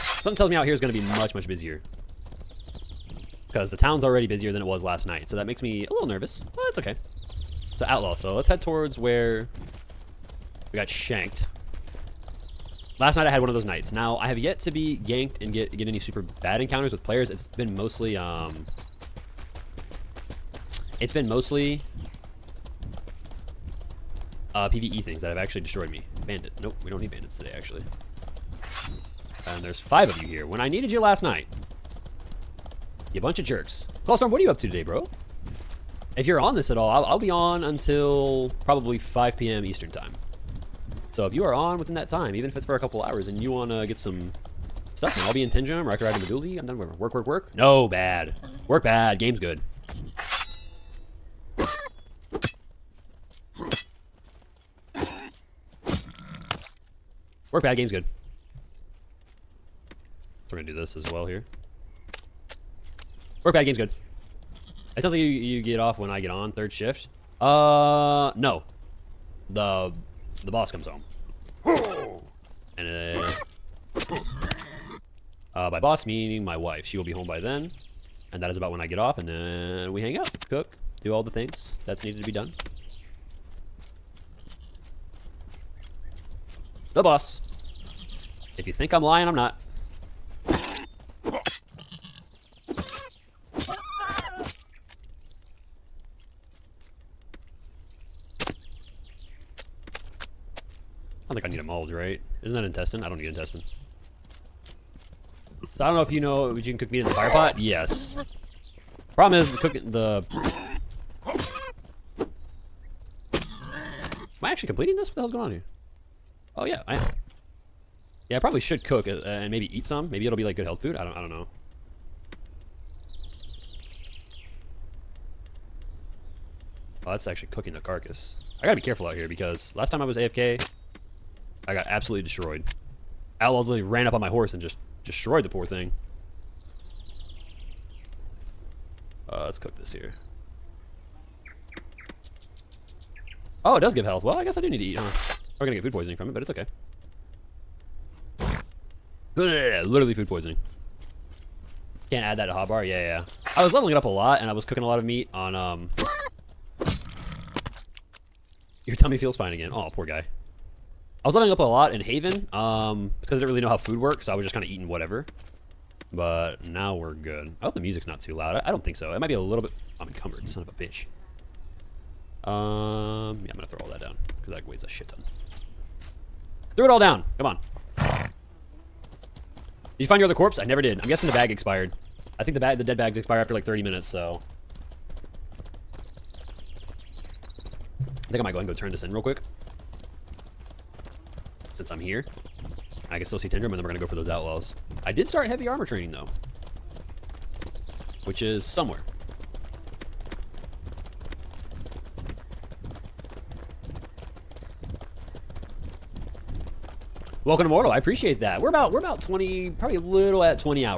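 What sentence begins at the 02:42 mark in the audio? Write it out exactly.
Um, it's because I didn't really know how food works, so I was just kind of eating whatever.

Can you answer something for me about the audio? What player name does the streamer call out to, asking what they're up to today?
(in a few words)
Clawstorm.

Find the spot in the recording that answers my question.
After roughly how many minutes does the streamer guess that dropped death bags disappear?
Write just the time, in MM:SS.
03:03.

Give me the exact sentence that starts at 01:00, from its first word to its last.
So we're gonna do this as well here.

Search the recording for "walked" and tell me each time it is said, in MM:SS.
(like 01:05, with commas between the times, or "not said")
not said.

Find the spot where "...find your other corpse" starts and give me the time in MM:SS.
03:00.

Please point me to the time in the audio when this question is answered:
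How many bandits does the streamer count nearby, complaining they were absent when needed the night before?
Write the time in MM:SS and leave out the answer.
00:29.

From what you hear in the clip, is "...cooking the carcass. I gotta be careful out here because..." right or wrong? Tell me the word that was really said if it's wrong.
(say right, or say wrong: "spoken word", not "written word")
right.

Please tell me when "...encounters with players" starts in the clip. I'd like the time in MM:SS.
00:16.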